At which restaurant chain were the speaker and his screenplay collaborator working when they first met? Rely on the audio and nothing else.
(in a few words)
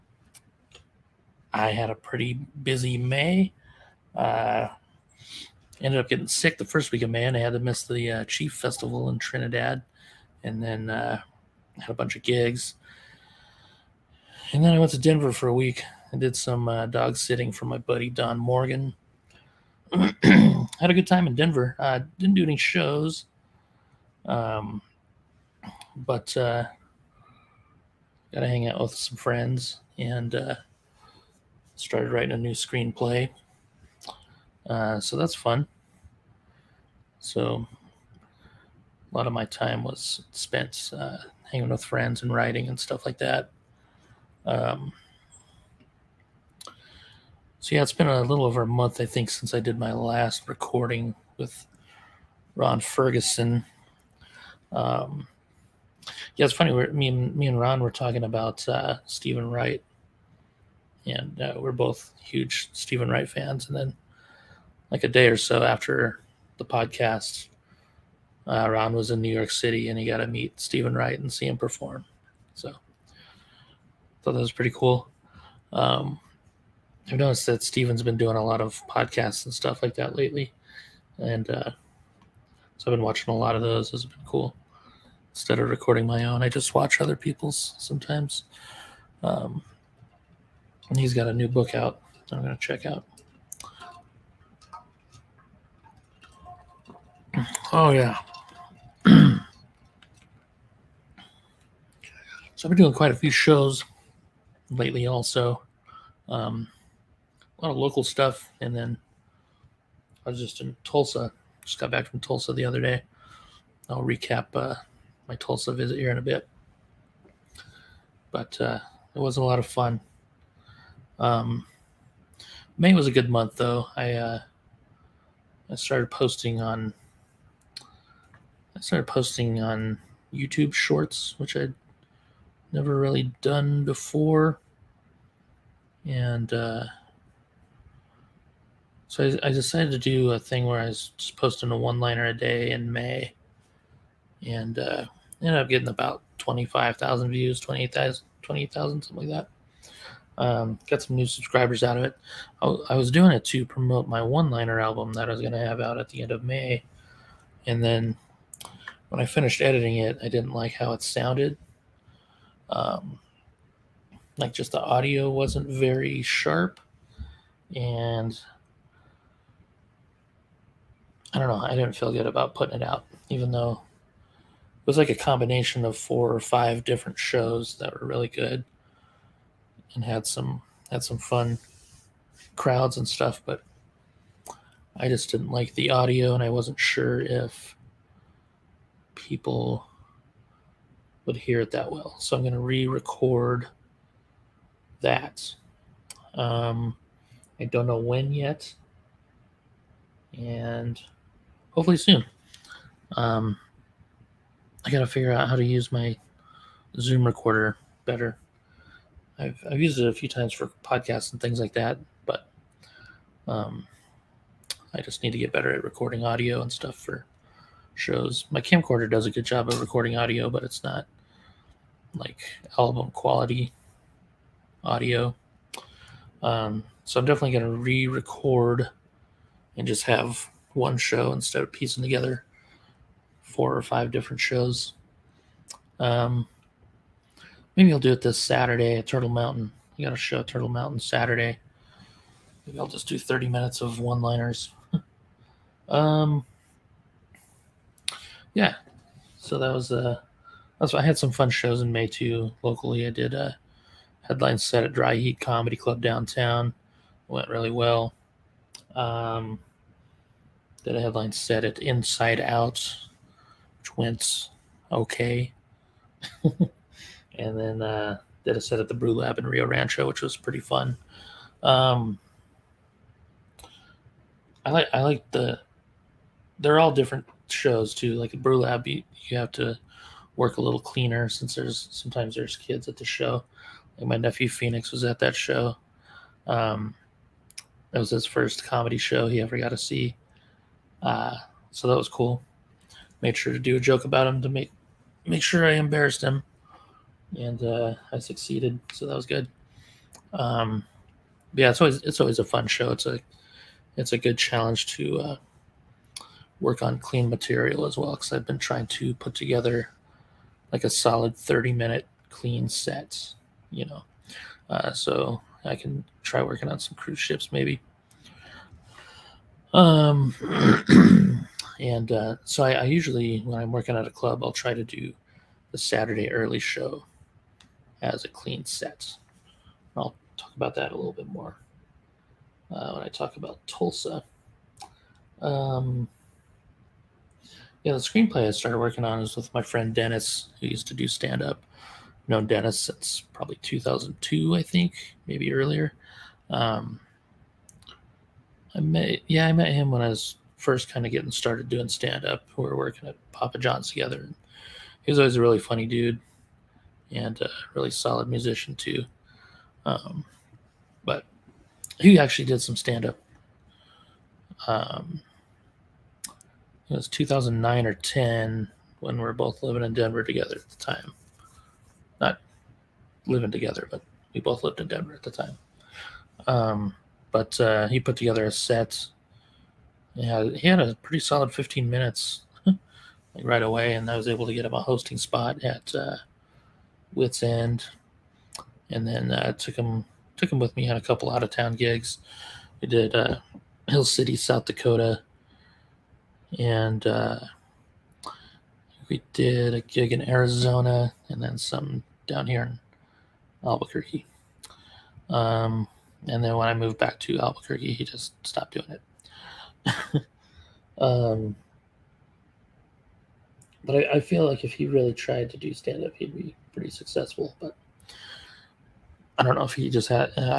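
Papa John's.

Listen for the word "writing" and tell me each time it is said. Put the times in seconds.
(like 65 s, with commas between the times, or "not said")
32 s, 42 s.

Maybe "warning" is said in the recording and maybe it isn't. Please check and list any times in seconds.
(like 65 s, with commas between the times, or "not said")
not said.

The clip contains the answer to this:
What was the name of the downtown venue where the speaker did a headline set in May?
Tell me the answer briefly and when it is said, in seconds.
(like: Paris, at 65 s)
Dry Heat Comedy Club, at 254 s.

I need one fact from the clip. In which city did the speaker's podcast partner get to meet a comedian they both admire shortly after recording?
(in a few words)
New York City.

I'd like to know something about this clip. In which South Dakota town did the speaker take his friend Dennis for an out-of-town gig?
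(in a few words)
Hill City.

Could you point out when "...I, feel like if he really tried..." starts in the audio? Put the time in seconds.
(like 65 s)
414 s.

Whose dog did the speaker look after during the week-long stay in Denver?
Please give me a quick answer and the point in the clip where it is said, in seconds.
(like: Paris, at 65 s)
Don Morgan, at 18 s.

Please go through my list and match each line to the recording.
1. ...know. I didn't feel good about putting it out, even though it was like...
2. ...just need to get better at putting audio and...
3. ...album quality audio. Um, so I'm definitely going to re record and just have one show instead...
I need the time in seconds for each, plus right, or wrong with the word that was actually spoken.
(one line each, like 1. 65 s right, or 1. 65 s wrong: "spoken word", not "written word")
1. 171 s right
2. 215 s wrong: "recording", not "putting"
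3. 222 s right.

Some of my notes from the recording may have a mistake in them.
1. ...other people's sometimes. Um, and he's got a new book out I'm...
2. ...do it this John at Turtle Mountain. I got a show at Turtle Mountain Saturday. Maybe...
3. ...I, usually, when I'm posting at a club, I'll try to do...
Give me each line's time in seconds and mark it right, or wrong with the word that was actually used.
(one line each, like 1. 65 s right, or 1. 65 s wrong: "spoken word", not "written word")
1. 86 s right
2. 237 s wrong: "Saturday", not "John"
3. 322 s wrong: "working", not "posting".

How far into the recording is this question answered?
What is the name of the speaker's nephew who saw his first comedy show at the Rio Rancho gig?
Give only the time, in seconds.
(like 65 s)
284 s.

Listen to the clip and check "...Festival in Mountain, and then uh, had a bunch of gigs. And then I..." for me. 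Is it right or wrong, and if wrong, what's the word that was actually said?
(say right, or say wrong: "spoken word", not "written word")
wrong: "Trinidad", not "Mountain".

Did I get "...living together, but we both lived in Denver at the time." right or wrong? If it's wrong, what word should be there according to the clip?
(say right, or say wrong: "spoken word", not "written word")
right.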